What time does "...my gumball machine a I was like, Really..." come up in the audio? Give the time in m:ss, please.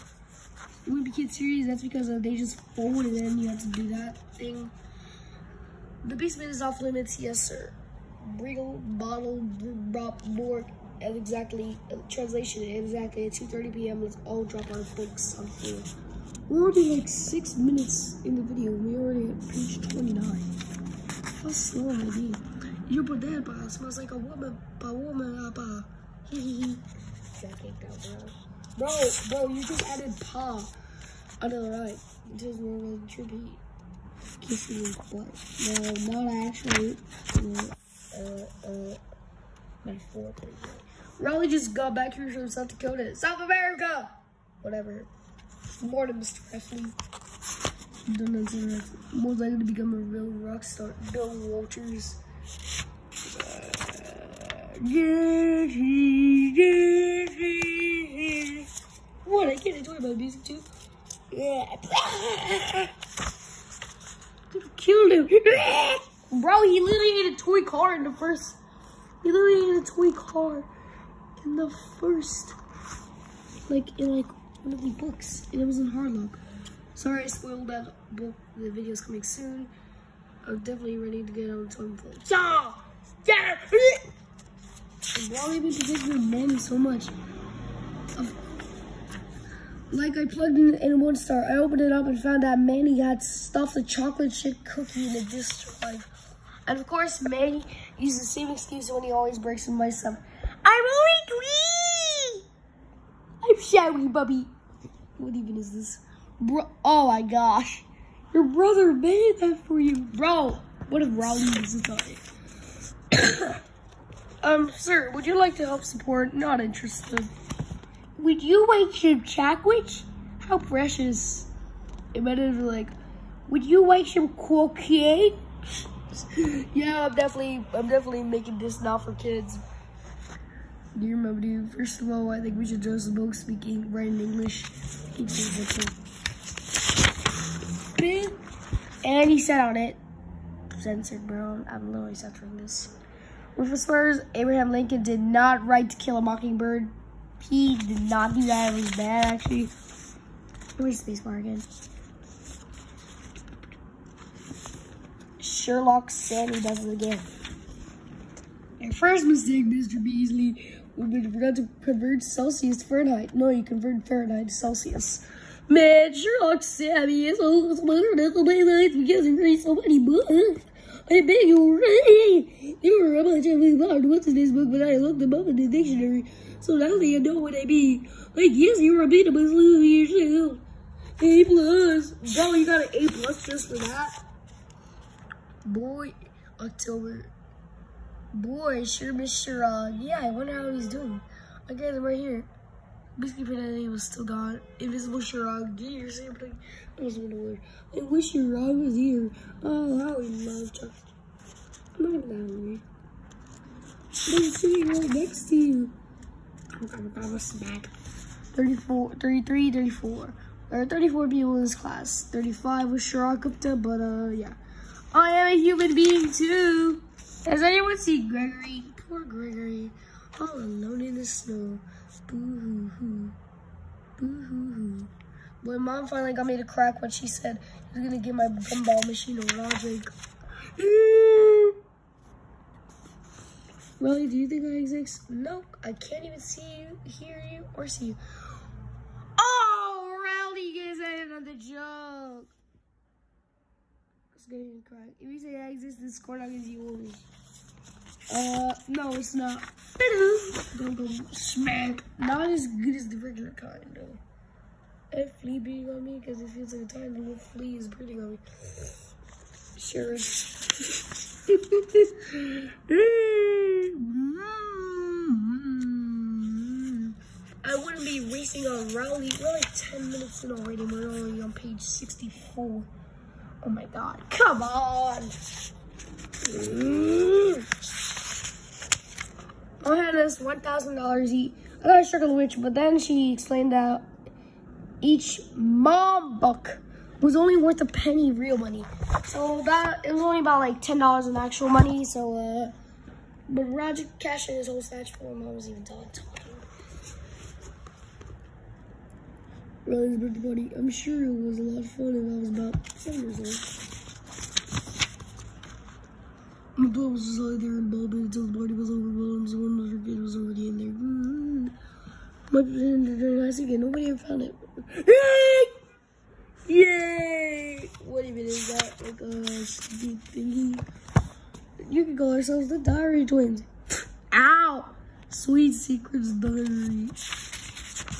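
3:48.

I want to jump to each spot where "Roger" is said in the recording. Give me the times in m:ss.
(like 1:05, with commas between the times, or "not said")
4:53, 4:59.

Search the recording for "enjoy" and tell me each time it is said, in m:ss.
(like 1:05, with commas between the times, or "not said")
0:59.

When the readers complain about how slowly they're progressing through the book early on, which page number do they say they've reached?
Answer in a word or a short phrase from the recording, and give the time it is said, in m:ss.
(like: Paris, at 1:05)
29, at 0:19.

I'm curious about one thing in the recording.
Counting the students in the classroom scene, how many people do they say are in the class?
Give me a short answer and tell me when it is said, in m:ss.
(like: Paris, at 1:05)
34, at 3:30.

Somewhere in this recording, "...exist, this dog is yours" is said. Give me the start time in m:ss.
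4:05.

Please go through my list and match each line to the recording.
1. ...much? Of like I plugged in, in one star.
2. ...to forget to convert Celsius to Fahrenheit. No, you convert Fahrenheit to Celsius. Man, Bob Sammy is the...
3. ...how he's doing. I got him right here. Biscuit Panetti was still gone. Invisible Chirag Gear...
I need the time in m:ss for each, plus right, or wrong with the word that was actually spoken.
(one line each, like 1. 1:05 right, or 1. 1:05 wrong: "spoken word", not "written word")
1. 1:26 right
2. 2:41 wrong: "Sherlock", not "Bob"
3. 3:10 right.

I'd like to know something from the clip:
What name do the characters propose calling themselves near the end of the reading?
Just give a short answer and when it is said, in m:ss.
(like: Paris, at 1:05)
the Diary Twins, at 5:22.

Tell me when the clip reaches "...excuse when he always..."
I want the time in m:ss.
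1:38.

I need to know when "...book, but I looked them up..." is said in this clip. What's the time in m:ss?
2:54.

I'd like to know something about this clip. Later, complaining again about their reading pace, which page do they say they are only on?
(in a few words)
64.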